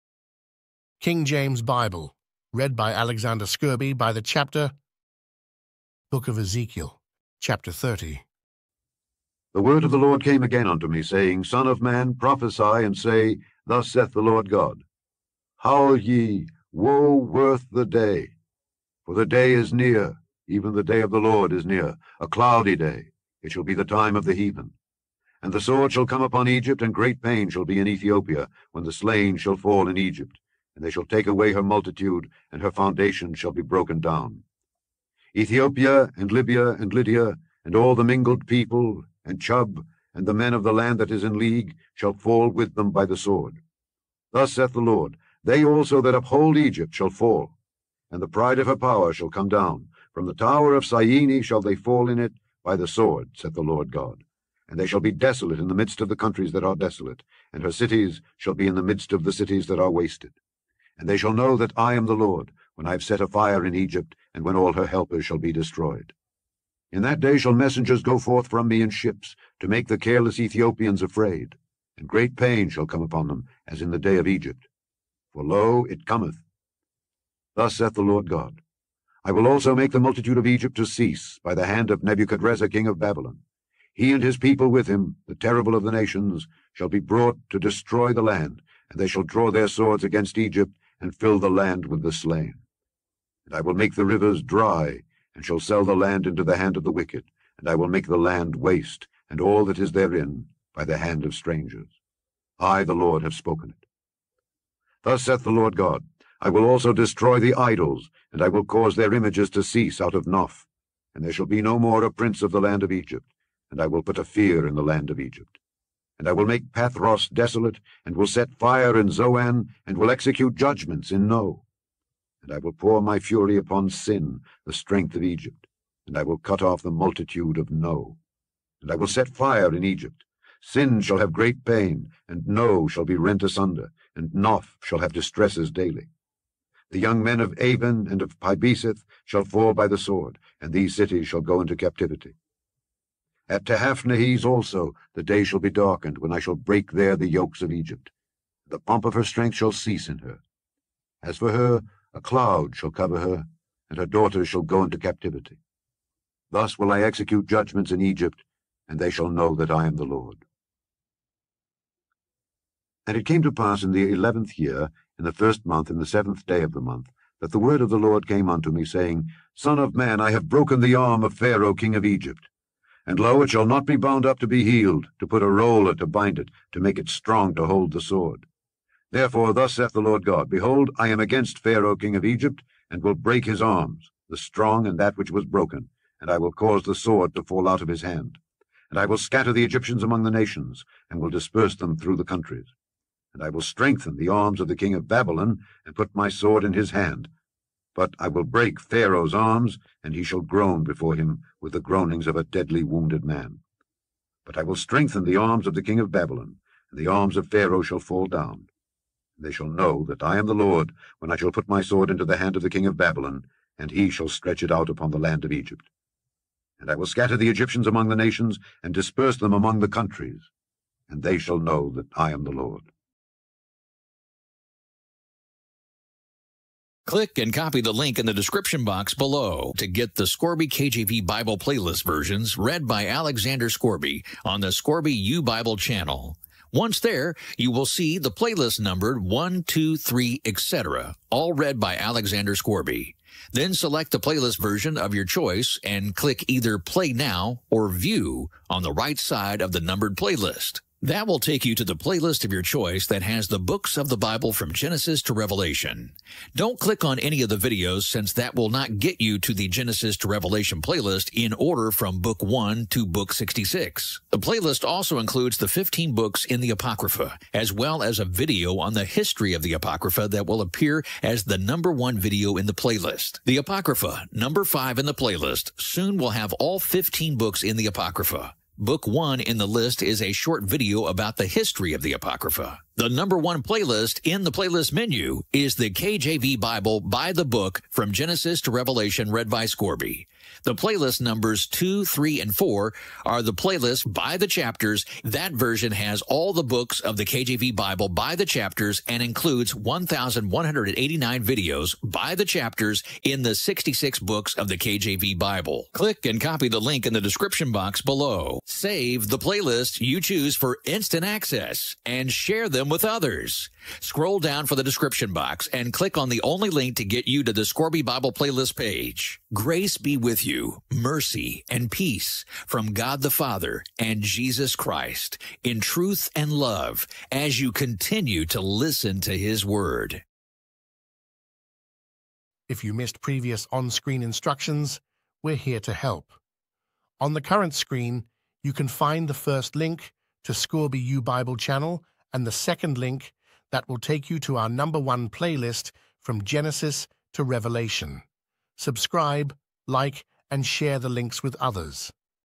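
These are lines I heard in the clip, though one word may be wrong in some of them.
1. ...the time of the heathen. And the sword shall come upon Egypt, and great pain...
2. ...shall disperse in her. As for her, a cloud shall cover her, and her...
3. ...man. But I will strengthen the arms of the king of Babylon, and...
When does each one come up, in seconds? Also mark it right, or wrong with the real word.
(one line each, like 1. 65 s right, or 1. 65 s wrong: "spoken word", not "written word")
1. 23 s right
2. 149 s wrong: "cease", not "disperse"
3. 203 s right.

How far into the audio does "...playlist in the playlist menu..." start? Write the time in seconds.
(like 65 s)
283 s.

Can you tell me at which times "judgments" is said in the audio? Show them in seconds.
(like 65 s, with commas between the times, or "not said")
120 s, 157 s.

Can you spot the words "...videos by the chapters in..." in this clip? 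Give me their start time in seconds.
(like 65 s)
301 s.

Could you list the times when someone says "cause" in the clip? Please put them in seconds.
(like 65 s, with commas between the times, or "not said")
108 s, 186 s.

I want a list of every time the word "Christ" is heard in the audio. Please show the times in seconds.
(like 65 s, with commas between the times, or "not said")
324 s.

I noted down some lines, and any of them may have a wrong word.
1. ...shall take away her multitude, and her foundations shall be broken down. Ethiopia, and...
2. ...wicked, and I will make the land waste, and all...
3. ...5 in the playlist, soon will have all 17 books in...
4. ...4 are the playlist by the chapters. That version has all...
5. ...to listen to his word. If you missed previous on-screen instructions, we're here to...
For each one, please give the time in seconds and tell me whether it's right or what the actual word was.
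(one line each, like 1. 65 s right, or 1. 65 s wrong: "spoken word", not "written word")
1. 30 s right
2. 96 s right
3. 274 s wrong: "15", not "17"
4. 292 s right
5. 328 s right.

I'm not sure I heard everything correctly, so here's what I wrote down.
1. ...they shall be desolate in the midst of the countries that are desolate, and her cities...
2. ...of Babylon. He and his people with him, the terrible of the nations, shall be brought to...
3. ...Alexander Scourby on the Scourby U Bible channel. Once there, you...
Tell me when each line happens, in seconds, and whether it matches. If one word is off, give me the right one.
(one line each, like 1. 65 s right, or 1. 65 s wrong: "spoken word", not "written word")
1. 54 s right
2. 82 s right
3. 233 s right.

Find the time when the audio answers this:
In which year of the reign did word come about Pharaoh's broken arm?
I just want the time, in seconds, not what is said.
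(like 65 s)
164 s.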